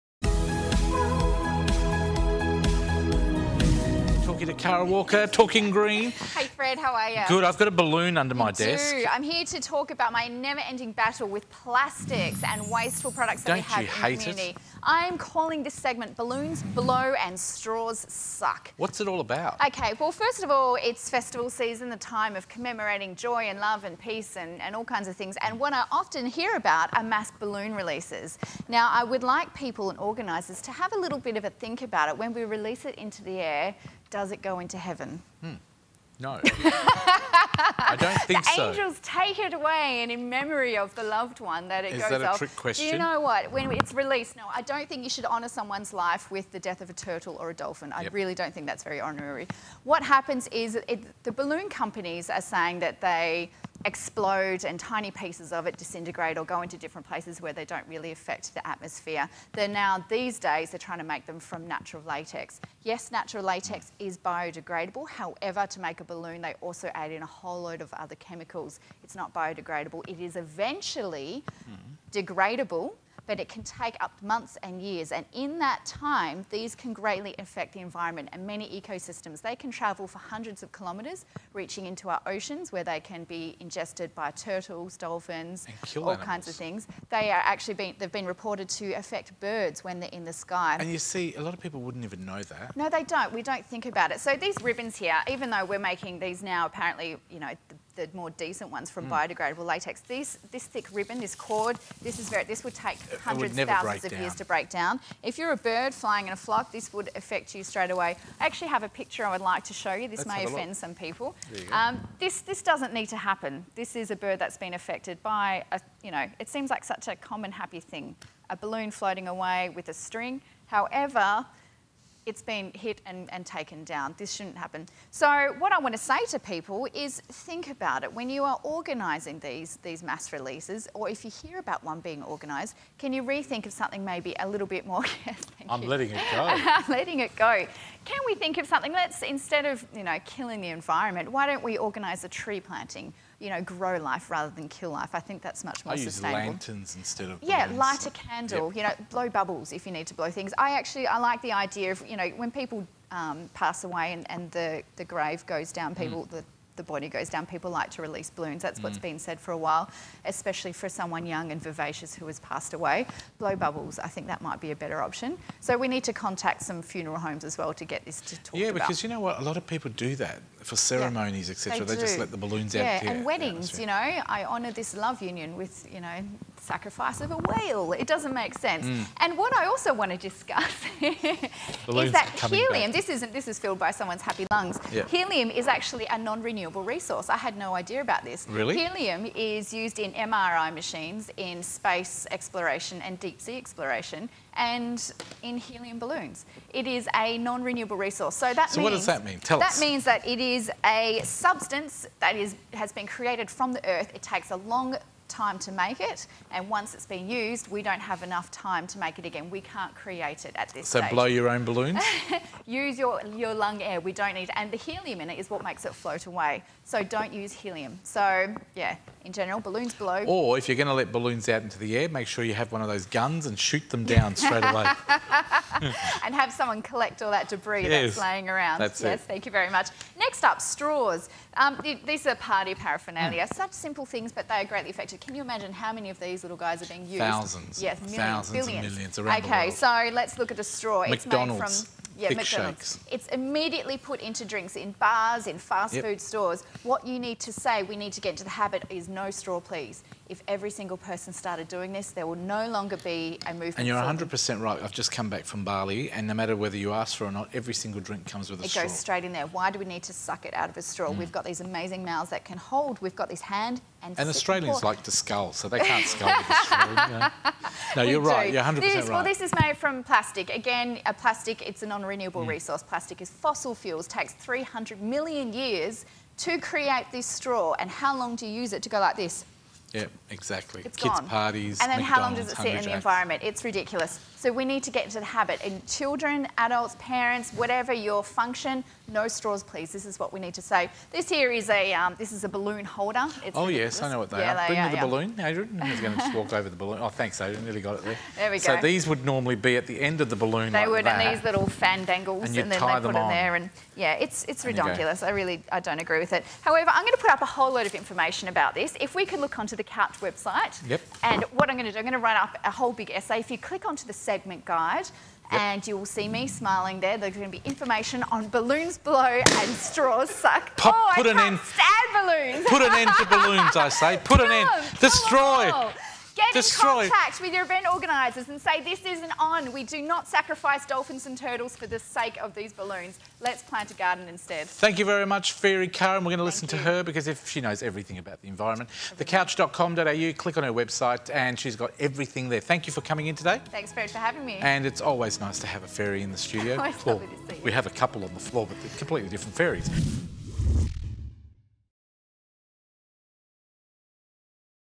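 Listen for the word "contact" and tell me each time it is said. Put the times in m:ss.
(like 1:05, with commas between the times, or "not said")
2:46, 5:27.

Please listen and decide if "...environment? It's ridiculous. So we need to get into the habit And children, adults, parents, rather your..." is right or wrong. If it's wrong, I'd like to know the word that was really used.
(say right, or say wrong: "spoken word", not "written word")
wrong: "whatever", not "rather".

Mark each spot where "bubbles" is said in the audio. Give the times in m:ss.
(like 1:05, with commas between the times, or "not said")
2:29, 2:43.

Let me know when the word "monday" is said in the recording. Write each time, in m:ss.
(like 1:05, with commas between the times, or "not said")
not said.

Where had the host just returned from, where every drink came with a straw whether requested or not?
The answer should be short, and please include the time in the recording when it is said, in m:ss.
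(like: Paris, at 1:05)
Bali, at 4:15.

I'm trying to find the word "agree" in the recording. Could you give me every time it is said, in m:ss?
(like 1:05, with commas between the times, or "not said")
5:05.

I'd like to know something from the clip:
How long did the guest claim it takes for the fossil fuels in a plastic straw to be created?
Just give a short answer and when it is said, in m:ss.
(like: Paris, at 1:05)
300 million years, at 4:34.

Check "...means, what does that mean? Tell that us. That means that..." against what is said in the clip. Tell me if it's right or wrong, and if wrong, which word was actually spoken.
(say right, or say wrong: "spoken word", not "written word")
right.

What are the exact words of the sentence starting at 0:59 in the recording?
They're now, these days, they're trying to make them from natural latex.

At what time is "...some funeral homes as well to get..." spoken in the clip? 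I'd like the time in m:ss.
2:46.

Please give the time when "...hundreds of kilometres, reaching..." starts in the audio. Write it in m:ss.
1:20.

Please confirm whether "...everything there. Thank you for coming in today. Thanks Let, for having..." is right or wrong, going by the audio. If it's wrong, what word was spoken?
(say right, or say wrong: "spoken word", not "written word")
wrong: "Fairy", not "Let".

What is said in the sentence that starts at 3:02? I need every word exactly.
this isn't this is filled by someone's happy lungs.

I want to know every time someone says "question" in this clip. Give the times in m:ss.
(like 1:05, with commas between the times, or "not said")
0:42.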